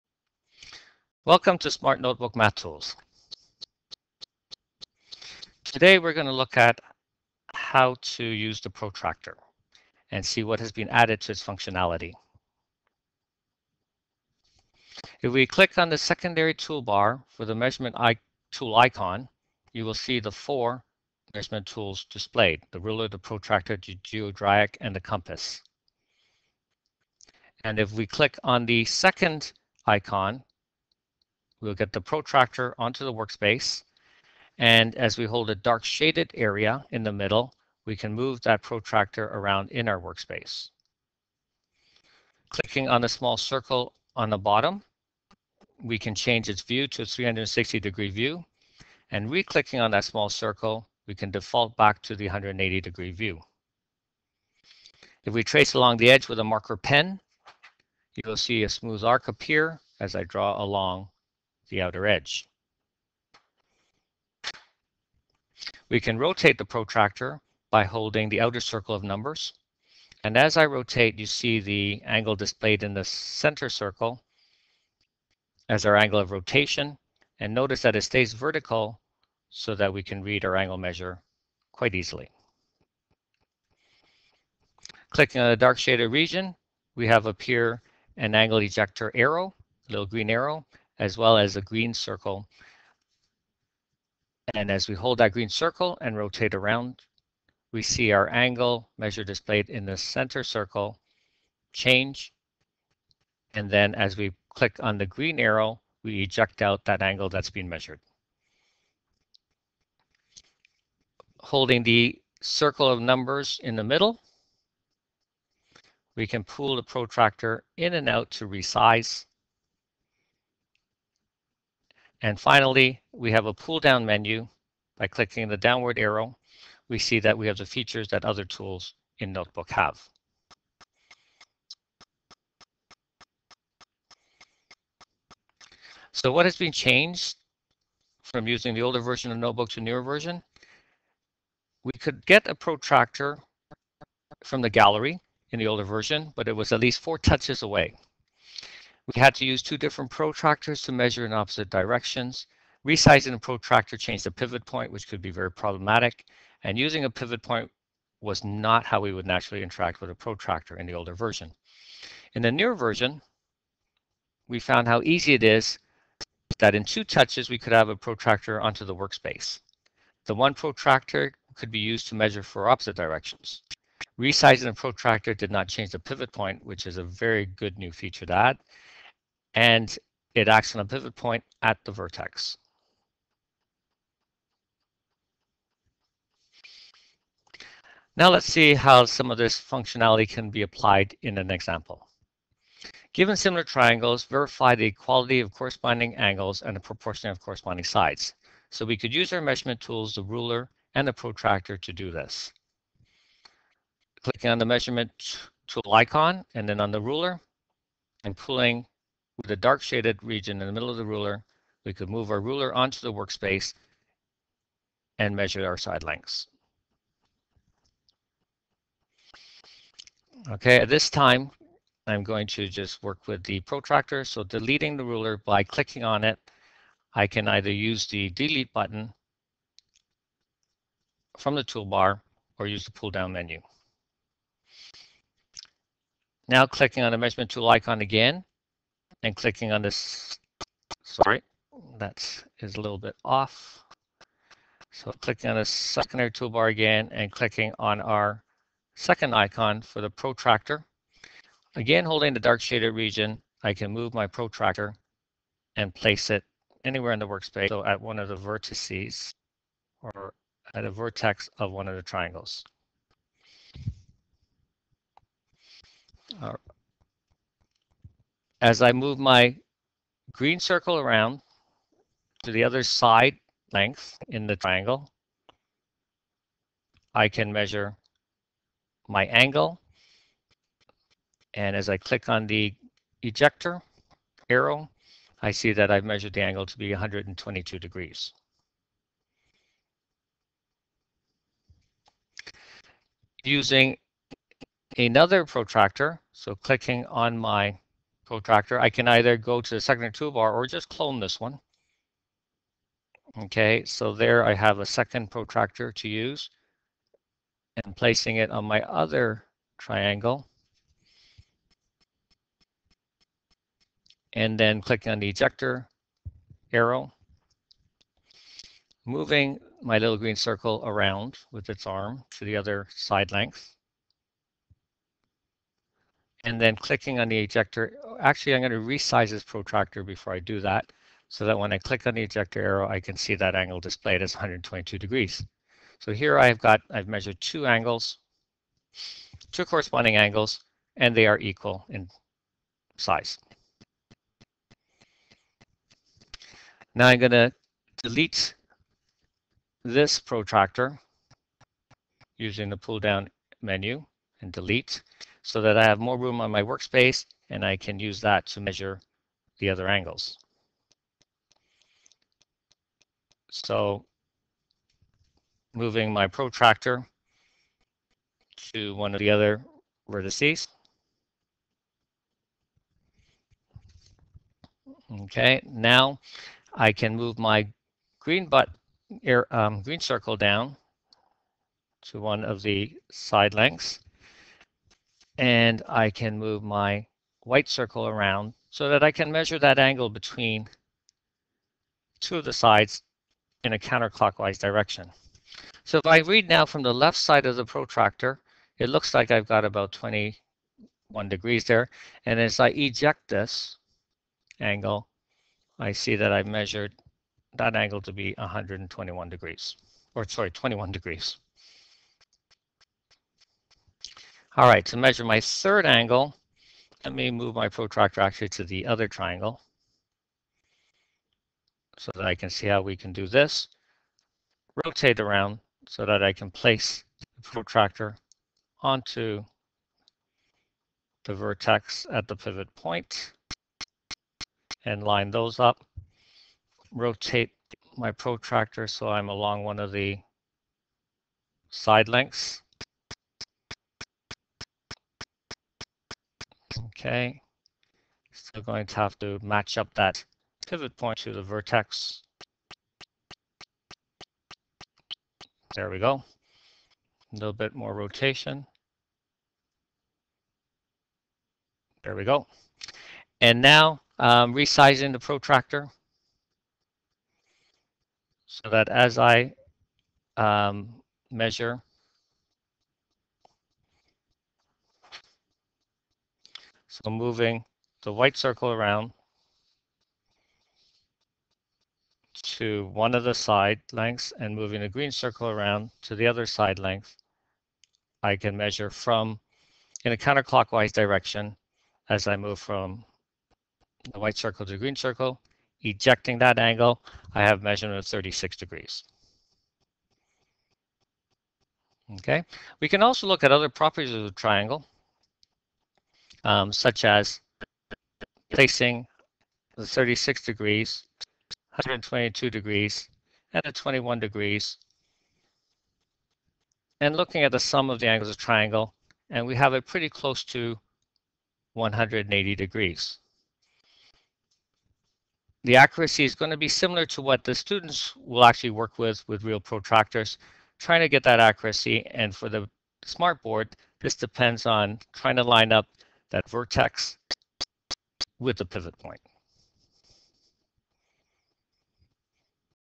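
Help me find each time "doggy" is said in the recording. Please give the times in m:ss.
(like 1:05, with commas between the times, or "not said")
not said.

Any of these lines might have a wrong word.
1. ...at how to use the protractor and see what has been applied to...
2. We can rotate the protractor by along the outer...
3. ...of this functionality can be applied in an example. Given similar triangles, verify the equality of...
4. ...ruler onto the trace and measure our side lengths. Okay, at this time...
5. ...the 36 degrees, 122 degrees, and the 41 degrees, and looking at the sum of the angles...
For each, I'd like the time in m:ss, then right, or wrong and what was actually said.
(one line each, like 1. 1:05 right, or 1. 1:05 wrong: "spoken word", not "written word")
1. 0:06 wrong: "added", not "applied"
2. 1:05 wrong: "holding", not "along"
3. 3:09 right
4. 3:32 wrong: "workspace", not "trace"
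5. 8:29 wrong: "21", not "41".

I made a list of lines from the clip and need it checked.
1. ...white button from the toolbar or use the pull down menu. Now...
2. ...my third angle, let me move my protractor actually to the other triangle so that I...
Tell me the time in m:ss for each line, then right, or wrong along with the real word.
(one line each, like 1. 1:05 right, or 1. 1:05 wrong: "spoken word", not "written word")
1. 3:48 wrong: "delete", not "white"
2. 6:55 right.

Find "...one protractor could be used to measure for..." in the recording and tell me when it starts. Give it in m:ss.
2:50.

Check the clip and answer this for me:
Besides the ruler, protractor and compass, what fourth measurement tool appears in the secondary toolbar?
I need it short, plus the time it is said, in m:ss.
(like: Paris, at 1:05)
Geodreieck, at 0:23.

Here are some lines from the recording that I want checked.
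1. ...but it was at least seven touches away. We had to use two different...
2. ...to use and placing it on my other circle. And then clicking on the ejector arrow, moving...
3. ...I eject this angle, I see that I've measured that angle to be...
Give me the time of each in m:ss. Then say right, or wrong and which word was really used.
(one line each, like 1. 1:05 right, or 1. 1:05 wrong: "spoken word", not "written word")
1. 2:26 wrong: "four", not "seven"
2. 5:05 wrong: "triangle", not "circle"
3. 6:42 right.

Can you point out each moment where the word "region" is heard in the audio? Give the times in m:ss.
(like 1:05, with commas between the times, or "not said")
1:26, 3:30, 4:12.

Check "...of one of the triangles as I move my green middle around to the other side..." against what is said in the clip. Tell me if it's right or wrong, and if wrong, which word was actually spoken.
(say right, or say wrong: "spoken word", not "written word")
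wrong: "circle", not "middle".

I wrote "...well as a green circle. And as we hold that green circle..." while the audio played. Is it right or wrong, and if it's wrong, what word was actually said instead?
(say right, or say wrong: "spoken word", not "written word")
right.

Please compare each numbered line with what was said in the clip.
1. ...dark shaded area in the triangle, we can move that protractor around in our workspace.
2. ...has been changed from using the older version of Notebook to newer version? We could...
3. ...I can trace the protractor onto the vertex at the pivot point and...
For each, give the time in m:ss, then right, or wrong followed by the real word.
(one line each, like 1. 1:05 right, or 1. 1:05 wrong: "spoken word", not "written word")
1. 0:35 wrong: "middle", not "triangle"
2. 2:16 right
3. 7:06 wrong: "place", not "trace".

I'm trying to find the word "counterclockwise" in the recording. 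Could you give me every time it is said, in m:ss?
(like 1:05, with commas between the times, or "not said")
6:33, 8:10.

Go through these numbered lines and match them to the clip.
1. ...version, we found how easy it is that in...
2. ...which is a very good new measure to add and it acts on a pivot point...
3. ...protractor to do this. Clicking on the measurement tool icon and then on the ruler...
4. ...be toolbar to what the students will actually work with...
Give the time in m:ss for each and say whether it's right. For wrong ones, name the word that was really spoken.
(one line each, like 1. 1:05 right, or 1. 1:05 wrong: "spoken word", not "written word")
1. 2:42 right
2. 2:56 wrong: "feature", not "measure"
3. 3:21 right
4. 8:46 wrong: "similar", not "toolbar".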